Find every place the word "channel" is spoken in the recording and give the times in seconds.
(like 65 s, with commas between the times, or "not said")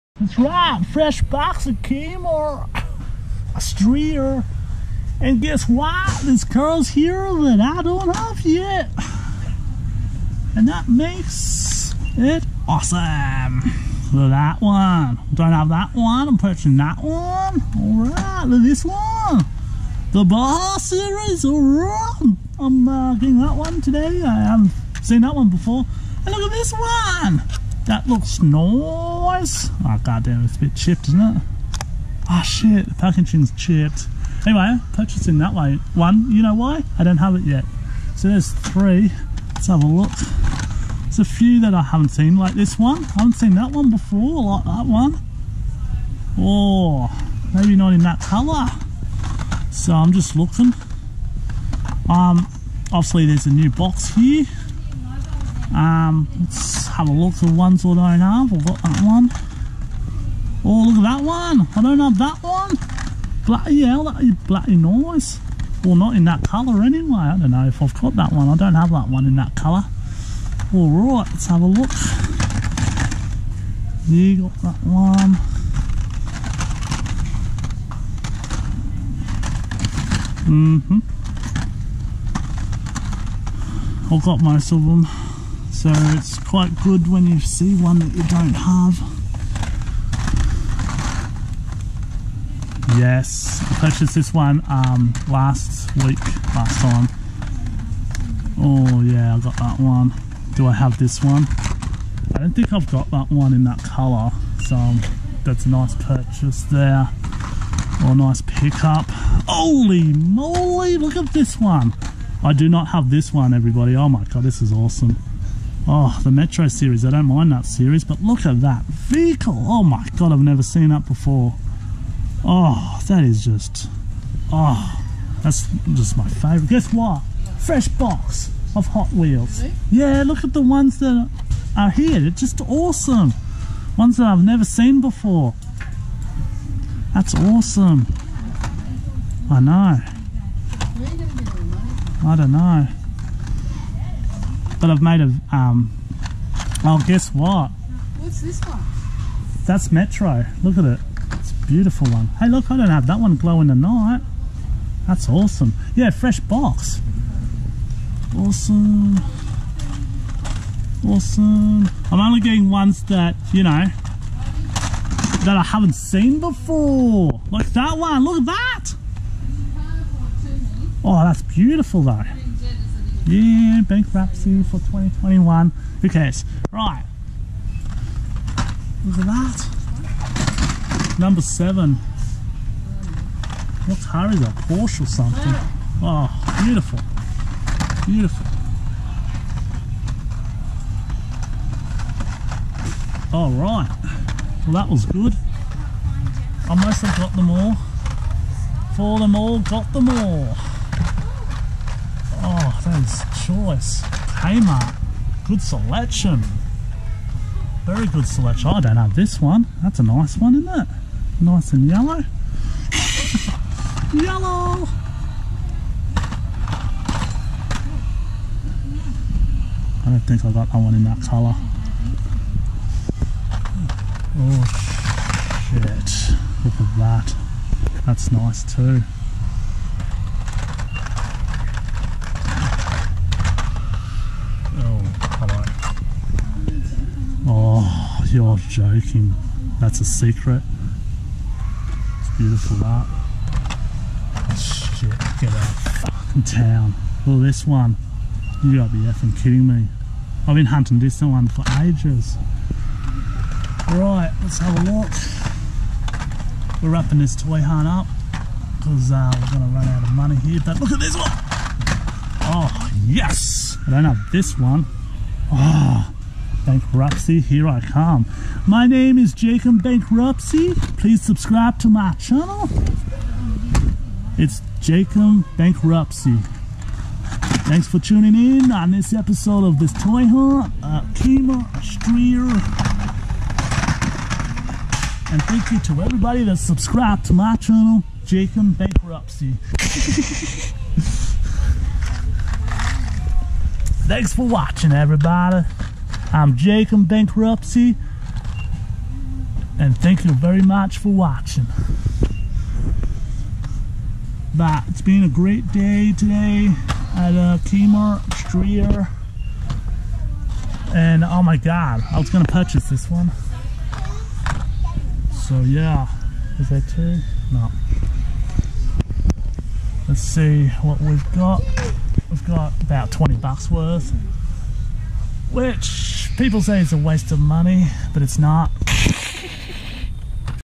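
272 s, 287 s.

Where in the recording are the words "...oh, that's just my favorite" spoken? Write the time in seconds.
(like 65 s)
124 s.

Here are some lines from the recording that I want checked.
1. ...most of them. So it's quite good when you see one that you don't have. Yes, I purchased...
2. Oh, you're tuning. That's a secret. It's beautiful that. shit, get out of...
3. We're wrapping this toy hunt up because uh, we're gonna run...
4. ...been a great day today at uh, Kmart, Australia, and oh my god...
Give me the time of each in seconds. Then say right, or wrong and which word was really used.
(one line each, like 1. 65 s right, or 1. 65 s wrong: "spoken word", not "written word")
1. 84 s right
2. 237 s wrong: "joking", not "tuning"
3. 256 s right
4. 305 s wrong: "Streer", not "Australia".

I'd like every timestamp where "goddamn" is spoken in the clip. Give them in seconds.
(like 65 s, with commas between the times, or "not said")
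30 s.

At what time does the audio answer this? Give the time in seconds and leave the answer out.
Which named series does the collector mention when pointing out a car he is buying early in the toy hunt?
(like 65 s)
20 s.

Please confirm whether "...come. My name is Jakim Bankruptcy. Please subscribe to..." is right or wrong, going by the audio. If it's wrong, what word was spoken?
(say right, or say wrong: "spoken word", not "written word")
right.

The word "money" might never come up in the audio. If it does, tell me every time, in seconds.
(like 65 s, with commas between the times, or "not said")
260 s, 327 s.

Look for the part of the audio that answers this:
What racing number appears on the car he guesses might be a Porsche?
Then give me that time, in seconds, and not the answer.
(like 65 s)
181 s.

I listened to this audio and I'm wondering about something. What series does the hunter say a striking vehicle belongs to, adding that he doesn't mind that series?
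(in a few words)
Metro series.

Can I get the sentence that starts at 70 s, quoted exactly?
All right, let's have a look.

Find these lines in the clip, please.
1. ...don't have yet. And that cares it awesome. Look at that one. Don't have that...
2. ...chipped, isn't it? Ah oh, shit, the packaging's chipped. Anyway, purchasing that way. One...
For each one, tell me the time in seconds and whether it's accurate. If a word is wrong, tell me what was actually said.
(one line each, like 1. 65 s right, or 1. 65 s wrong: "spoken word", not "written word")
1. 7 s wrong: "makes", not "cares"
2. 30 s right.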